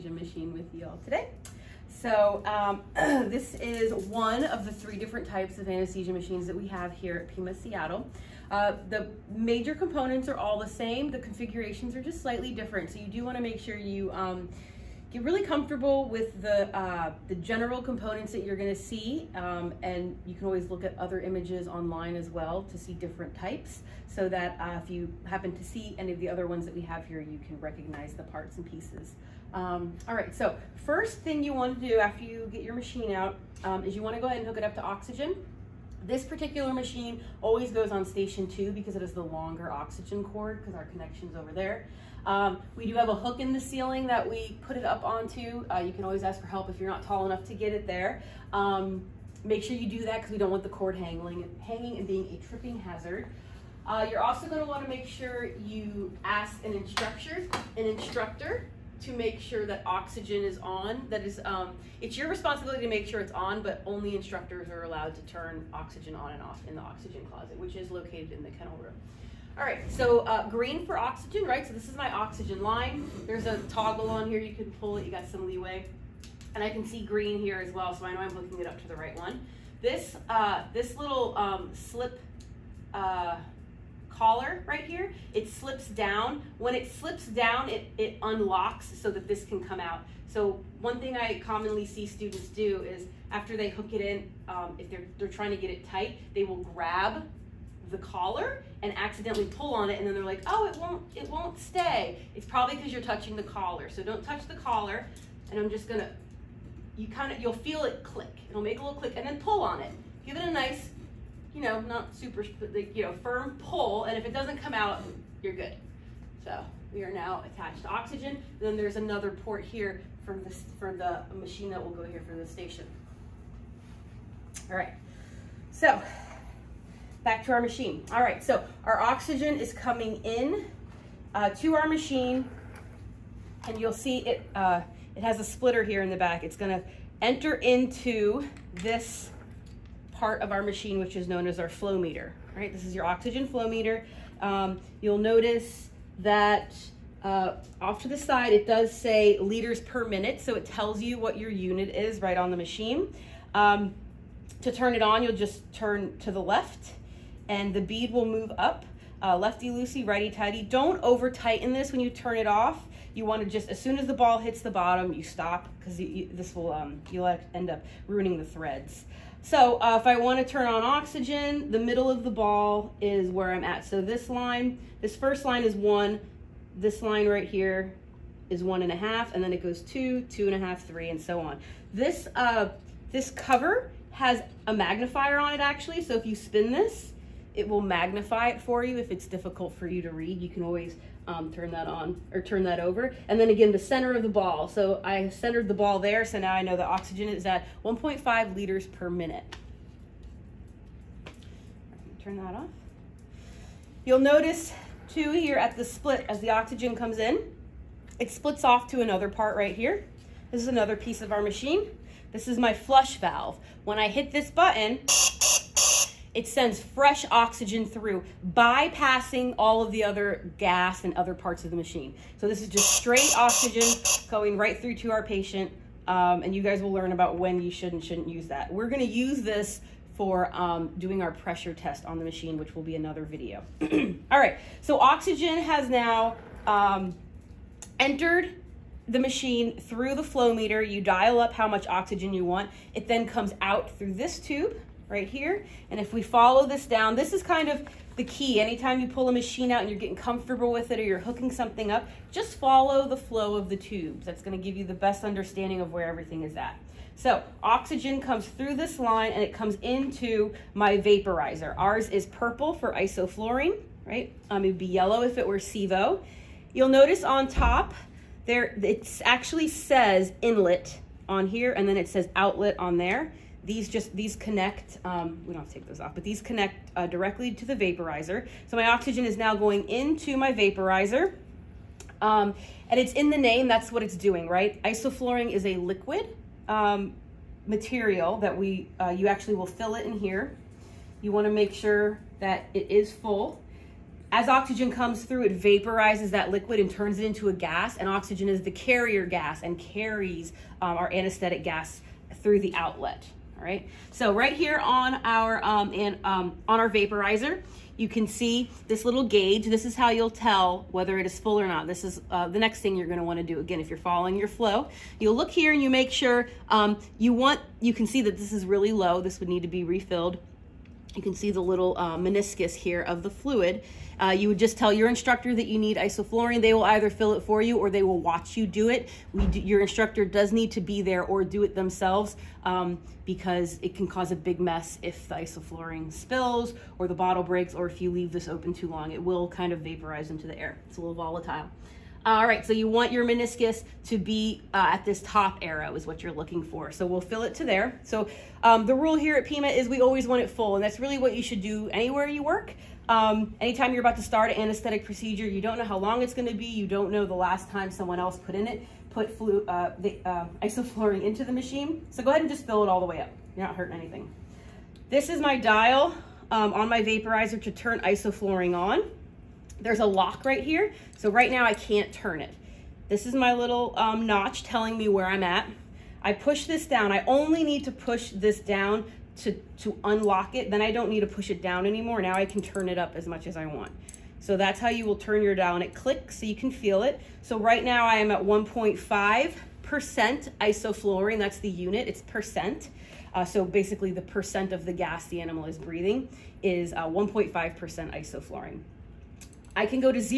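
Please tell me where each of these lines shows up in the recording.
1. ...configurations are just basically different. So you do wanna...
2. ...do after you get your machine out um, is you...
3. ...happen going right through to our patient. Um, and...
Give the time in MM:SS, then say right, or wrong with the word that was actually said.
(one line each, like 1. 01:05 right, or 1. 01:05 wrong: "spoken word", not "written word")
1. 00:11 wrong: "slightly", not "basically"
2. 00:31 right
3. 03:43 wrong: "oxygen", not "happen".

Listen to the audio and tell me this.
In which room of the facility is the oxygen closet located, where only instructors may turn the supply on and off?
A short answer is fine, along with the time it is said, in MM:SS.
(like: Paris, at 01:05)
Kennel room, at 01:08.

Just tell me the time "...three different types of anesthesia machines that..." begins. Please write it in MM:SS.
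00:04.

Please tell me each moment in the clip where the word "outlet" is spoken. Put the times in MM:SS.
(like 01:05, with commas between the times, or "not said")
04:32, 05:02.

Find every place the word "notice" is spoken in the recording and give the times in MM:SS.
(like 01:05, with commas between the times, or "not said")
02:25, 03:24, 04:26.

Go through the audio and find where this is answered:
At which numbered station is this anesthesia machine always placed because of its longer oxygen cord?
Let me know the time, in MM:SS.
00:38.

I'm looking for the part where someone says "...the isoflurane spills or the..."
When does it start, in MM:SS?
05:35.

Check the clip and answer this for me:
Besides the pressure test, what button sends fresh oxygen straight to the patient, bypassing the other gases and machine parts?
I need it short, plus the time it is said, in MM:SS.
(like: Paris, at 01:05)
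Flush valve, at 03:32.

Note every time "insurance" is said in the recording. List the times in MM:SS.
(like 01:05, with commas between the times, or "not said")
not said.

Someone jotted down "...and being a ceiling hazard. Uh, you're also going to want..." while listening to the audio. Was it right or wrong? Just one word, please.
wrong.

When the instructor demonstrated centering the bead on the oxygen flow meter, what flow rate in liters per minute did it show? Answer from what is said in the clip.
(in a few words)
1.5.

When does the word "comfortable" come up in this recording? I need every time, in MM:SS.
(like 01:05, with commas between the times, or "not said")
00:15, 04:10.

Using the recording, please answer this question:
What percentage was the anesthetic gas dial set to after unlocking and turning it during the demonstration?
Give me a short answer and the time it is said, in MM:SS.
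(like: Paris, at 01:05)
1.5%, at 06:28.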